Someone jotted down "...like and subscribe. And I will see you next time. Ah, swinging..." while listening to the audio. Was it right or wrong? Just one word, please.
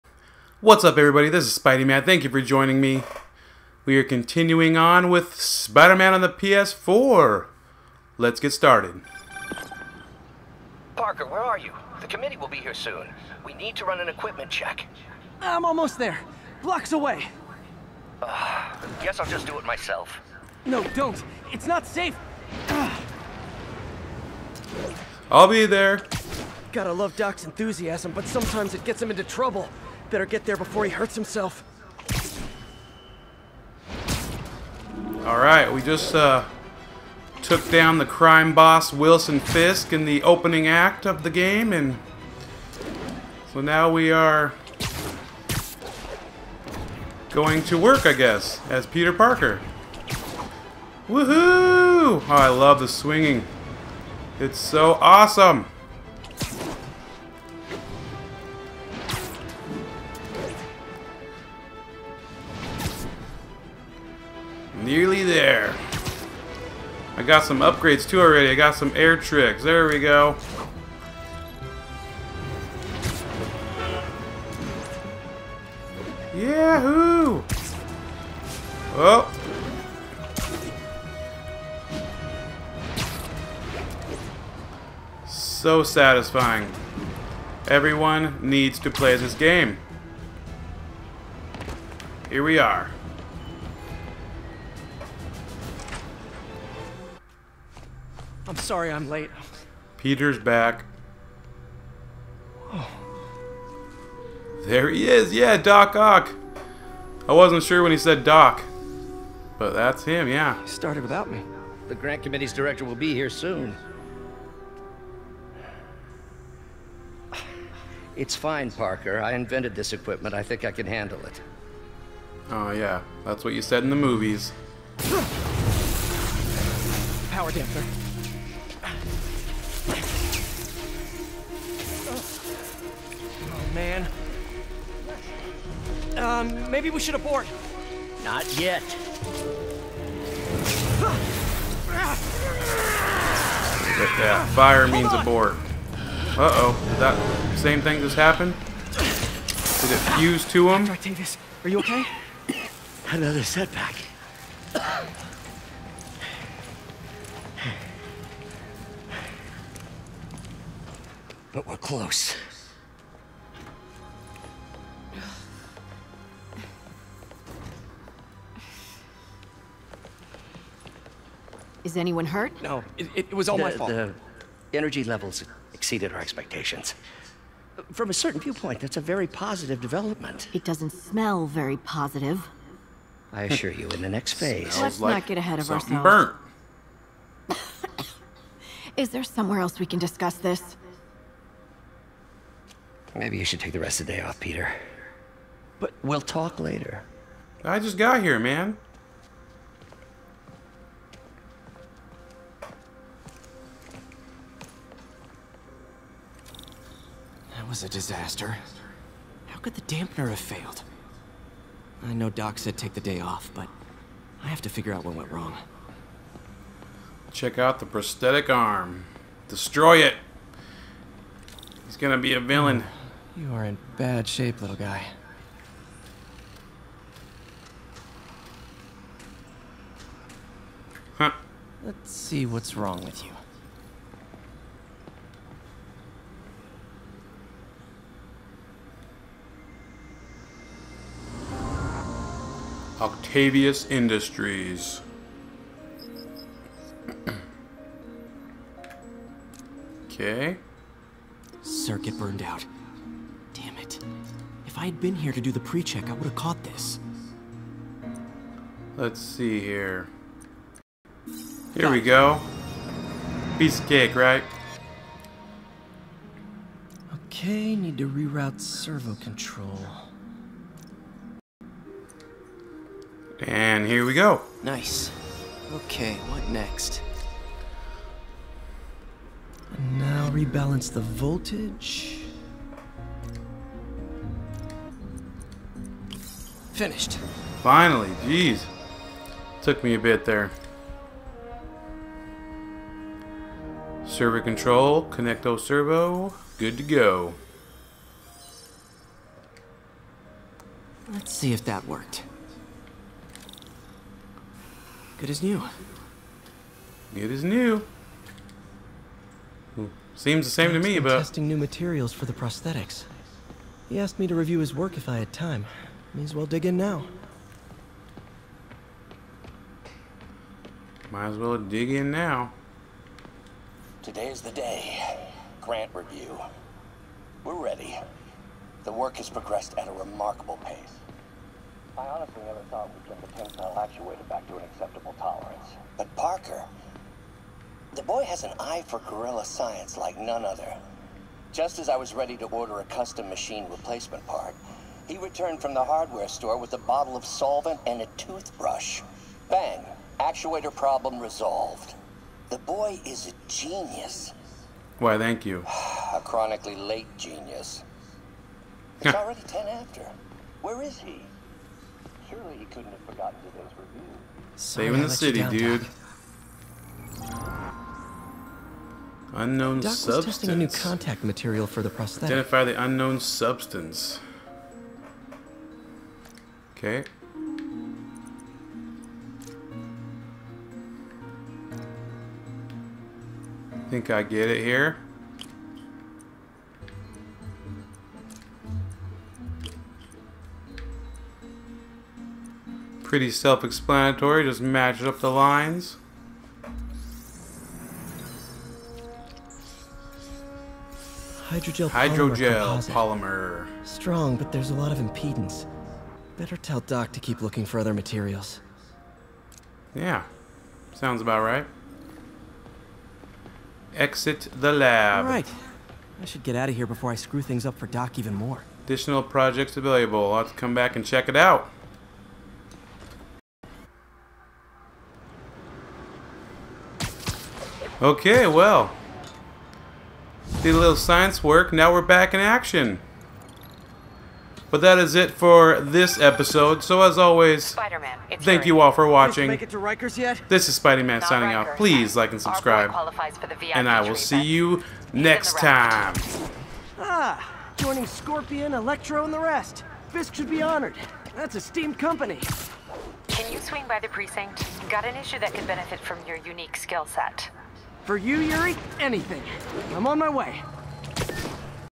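wrong.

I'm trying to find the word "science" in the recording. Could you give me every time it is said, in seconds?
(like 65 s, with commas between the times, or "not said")
339 s, 430 s.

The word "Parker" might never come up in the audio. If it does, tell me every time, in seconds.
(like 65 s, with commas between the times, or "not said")
10 s, 49 s, 118 s, 336 s.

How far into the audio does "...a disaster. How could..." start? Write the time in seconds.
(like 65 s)
207 s.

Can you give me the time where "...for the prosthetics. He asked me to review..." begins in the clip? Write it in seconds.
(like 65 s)
312 s.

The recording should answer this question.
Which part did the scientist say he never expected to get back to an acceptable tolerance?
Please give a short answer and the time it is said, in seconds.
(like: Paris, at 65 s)
tensile actuator, at 333 s.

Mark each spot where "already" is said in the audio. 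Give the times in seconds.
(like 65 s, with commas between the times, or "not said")
68 s, 359 s.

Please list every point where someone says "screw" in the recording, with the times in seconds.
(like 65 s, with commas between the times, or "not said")
417 s.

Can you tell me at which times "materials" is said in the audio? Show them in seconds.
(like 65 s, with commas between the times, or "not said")
311 s, 371 s, 407 s.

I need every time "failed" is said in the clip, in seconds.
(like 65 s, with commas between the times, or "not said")
210 s.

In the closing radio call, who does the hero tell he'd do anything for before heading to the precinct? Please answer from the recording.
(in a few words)
Yuri.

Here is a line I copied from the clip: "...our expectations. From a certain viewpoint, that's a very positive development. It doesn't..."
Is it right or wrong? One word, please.
right.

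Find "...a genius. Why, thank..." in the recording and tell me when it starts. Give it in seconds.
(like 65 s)
353 s.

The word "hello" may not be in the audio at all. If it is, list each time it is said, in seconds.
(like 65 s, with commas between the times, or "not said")
not said.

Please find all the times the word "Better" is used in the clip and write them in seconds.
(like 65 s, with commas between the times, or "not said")
30 s, 406 s.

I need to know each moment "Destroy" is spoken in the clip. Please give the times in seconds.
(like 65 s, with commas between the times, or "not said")
219 s.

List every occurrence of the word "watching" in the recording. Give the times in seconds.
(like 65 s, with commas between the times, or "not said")
439 s.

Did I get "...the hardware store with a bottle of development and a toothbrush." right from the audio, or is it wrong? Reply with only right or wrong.
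wrong.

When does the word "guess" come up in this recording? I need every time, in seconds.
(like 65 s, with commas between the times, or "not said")
19 s, 48 s.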